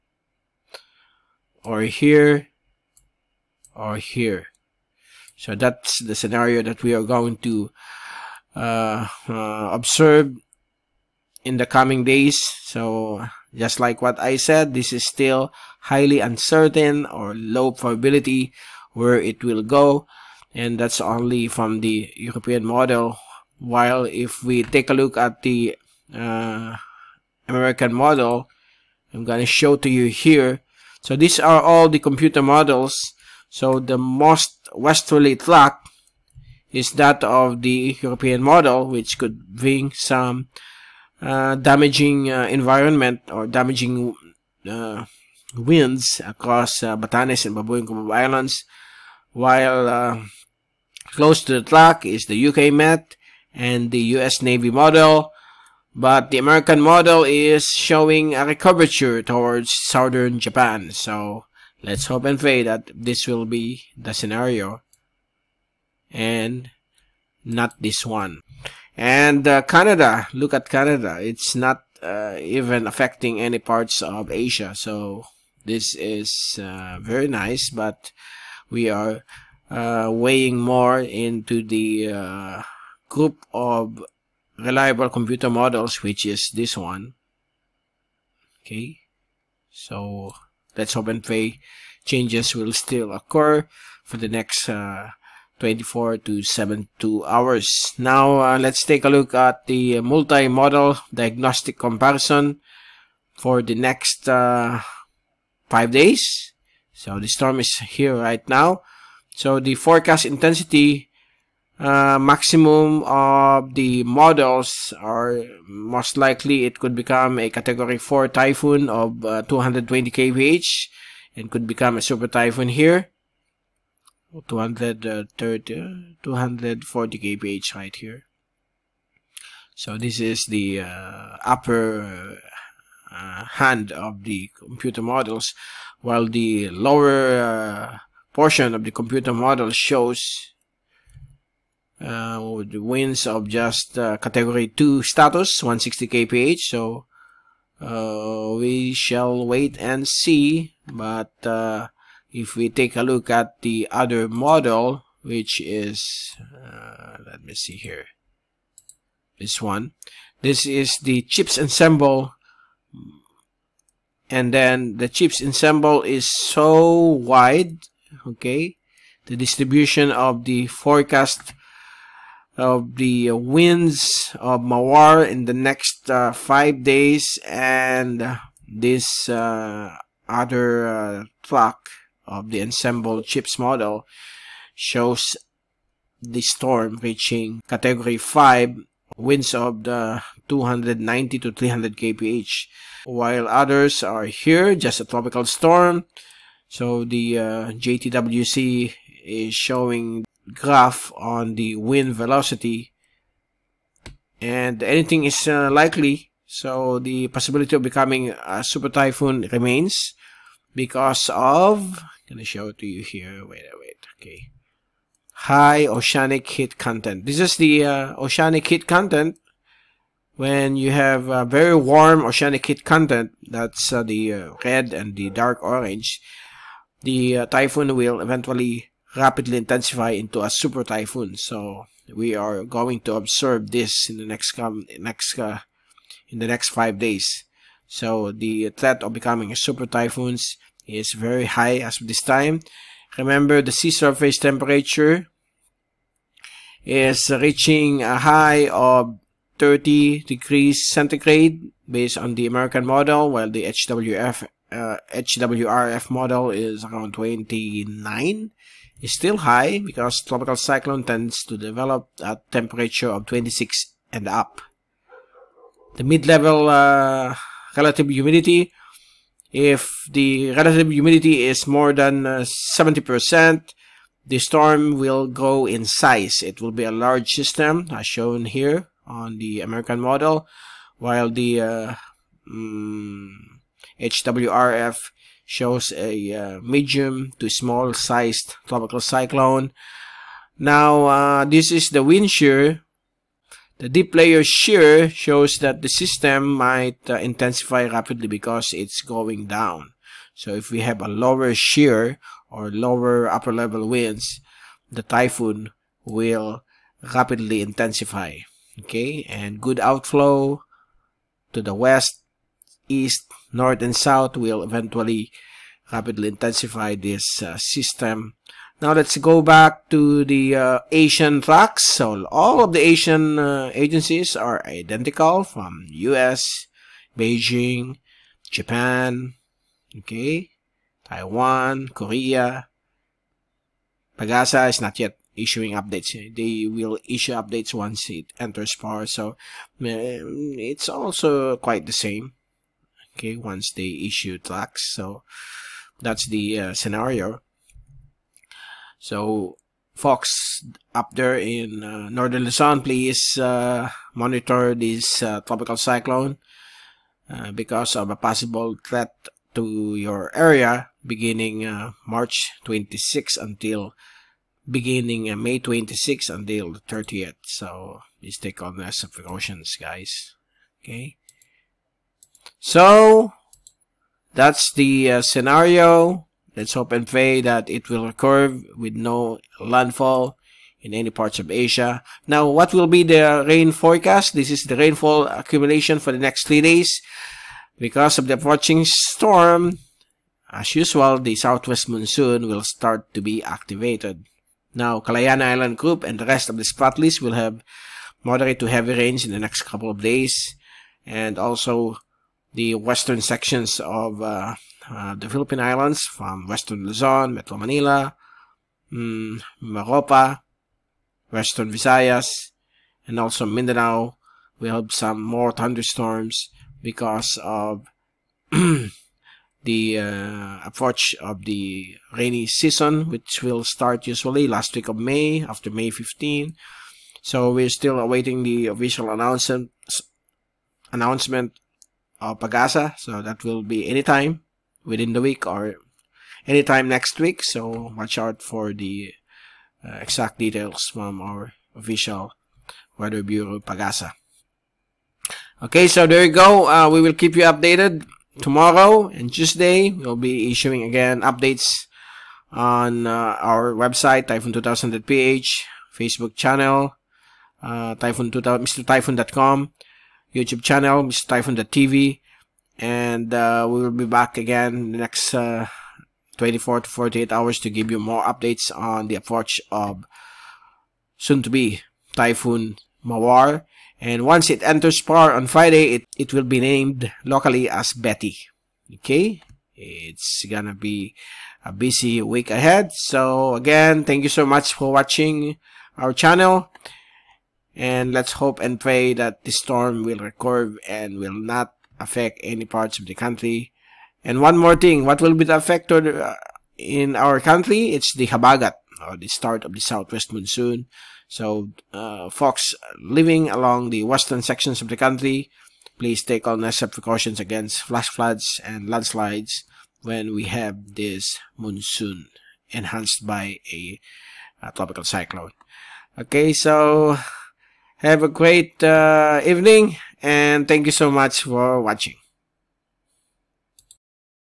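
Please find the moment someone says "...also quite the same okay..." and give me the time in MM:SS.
05:40.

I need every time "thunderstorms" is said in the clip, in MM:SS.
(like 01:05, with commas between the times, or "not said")
06:55.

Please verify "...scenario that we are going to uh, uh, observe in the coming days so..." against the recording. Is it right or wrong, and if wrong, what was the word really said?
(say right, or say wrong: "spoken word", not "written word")
right.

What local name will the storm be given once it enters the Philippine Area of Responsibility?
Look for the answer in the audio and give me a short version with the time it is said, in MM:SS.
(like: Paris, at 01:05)
Betty, at 07:57.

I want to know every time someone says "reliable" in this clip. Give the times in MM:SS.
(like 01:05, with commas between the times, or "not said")
01:24.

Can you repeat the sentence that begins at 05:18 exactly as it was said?
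Now let's go back to the uh, Asian tracks.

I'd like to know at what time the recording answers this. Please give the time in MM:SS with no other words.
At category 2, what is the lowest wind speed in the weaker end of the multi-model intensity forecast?
02:25.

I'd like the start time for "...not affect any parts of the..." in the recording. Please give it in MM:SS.
08:11.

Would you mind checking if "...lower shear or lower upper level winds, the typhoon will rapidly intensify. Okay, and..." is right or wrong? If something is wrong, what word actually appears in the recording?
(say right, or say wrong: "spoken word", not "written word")
right.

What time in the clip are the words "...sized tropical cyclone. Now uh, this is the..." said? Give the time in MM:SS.
04:47.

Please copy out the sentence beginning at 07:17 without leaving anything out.
So watch out for the uh, exact details from our official Weather Bureau Pagasa.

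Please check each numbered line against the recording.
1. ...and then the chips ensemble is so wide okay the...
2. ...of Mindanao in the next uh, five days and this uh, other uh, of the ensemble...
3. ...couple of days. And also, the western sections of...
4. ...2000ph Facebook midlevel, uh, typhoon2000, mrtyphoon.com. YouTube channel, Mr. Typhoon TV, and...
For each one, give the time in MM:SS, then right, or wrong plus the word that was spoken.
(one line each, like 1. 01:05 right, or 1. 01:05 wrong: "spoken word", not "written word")
1. 02:44 right
2. 02:54 wrong: "Mawar", not "Mindanao"
3. 06:39 right
4. 07:34 wrong: "channel", not "midlevel".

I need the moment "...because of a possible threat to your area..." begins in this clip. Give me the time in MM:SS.
05:57.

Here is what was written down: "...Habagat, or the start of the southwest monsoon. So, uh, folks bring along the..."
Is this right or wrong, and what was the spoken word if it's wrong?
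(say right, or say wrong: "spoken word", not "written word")
wrong: "living", not "bring".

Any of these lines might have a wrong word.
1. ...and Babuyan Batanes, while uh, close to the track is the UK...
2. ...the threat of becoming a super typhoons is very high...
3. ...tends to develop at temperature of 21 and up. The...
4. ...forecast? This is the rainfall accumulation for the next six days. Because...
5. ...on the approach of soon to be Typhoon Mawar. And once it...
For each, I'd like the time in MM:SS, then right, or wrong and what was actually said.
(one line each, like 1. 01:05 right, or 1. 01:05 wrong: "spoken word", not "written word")
1. 00:47 wrong: "Islands", not "Batanes"
2. 03:58 right
3. 04:21 wrong: "26", not "21"
4. 06:23 wrong: "three", not "six"
5. 07:48 right.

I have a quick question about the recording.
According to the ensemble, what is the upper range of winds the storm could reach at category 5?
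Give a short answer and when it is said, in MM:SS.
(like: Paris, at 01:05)
290 to 300 kph, at 03:10.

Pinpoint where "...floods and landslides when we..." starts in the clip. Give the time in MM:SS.
08:28.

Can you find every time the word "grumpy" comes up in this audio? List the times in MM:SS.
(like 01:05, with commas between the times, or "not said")
not said.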